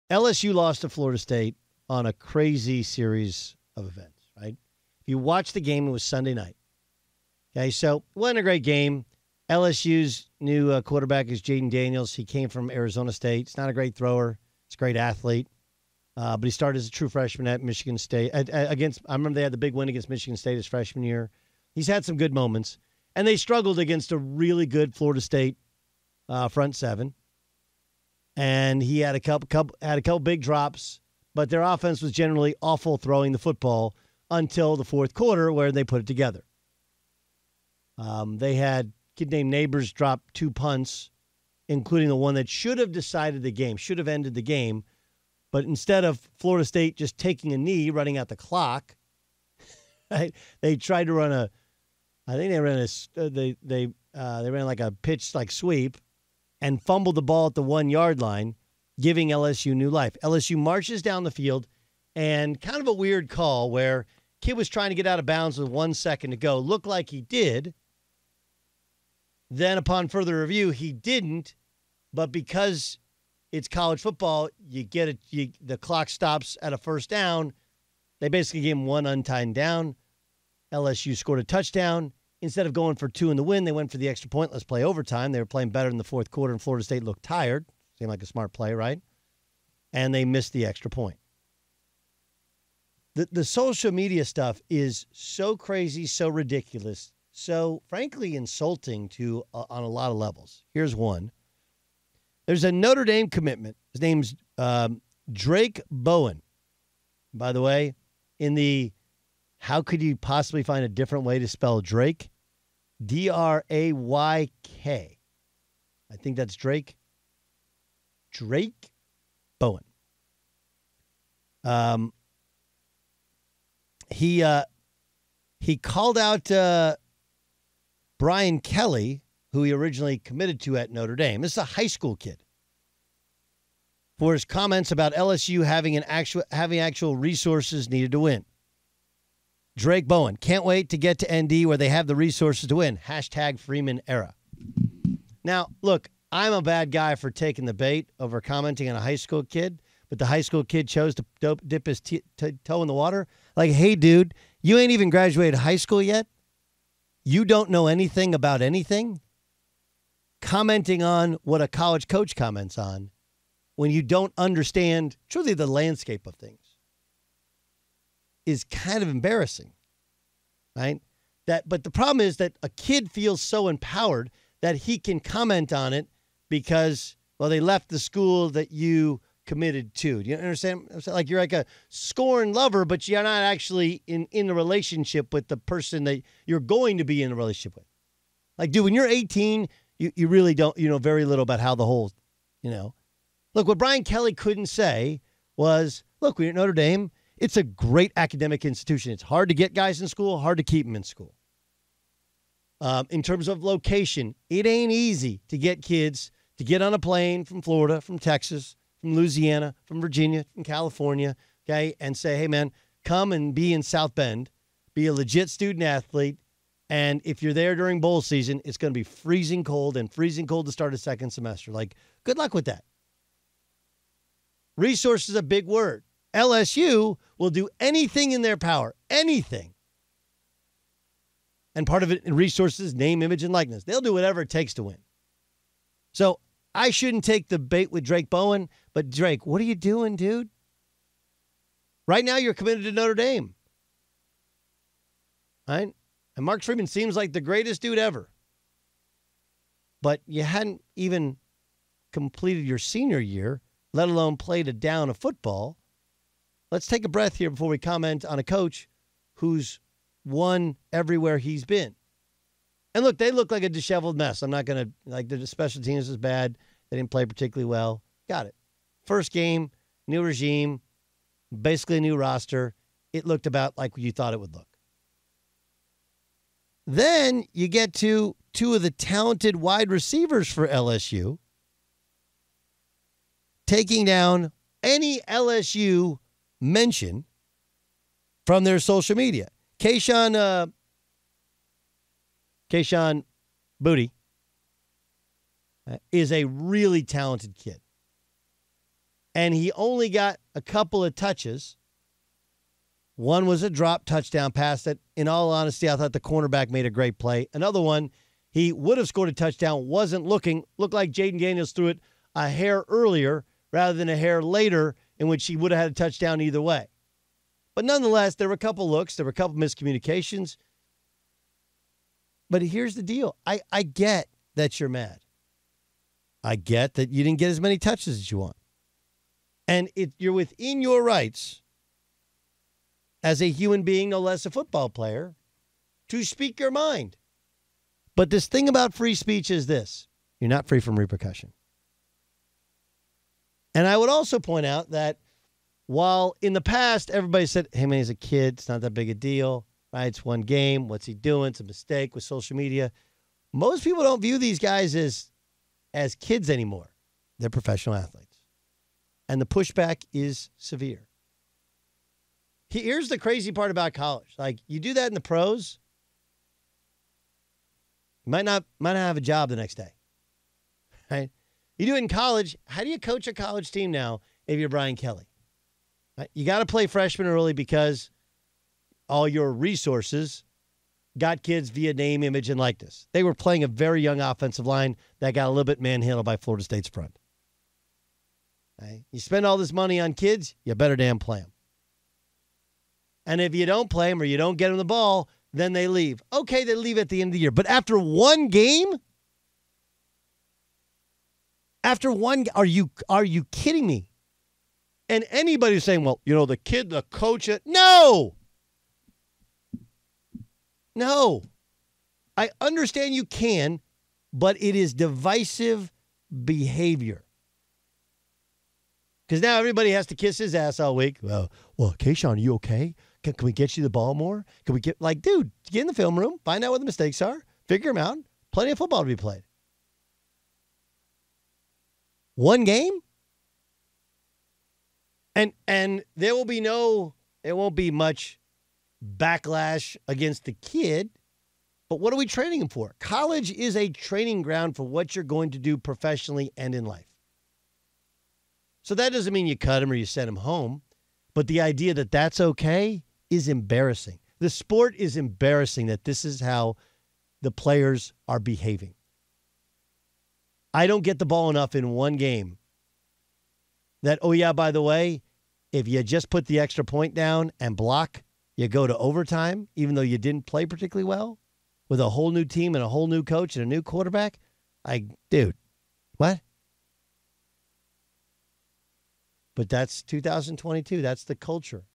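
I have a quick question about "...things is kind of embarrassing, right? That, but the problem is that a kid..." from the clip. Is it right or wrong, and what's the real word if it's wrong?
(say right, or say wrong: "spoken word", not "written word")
right.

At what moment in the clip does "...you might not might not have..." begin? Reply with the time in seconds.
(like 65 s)
368 s.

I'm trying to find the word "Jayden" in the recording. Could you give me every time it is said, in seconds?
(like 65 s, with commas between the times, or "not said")
11 s, 311 s.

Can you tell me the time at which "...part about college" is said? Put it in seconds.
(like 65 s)
363 s.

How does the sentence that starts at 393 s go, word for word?
And if you don't play them or you don't get them the ball, then they leave.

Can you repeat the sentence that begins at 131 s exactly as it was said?
This is a high school kid for his comments about LSU having an actual having actual resources needed to win.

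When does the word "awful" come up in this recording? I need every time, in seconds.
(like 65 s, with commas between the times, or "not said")
32 s.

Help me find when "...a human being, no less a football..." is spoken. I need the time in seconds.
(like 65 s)
333 s.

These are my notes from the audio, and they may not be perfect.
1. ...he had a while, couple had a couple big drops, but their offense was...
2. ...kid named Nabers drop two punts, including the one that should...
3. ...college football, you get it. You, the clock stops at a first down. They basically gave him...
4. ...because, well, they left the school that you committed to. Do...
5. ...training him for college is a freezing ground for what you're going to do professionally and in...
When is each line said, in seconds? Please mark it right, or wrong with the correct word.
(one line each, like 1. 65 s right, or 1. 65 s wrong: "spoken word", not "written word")
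1. 28 s wrong: "couple", not "while"
2. 39 s right
3. 73 s right
4. 176 s right
5. 442 s wrong: "training", not "freezing".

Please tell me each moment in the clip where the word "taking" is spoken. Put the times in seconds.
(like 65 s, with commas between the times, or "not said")
47 s, 147 s, 283 s.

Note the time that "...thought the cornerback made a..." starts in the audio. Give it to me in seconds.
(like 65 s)
305 s.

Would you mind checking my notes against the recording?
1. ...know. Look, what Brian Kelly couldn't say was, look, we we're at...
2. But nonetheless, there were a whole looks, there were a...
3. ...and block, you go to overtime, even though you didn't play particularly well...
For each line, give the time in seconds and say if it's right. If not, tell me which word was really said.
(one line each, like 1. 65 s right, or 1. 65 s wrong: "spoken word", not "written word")
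1. 192 s right
2. 317 s wrong: "couple", not "whole"
3. 467 s right.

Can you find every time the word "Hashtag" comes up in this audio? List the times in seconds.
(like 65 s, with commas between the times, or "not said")
142 s.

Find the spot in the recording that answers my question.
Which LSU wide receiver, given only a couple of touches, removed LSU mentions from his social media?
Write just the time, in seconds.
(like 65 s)
292 s.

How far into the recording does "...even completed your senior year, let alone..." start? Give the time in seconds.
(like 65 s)
250 s.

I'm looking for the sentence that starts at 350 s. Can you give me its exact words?
It's one game, what's he doing?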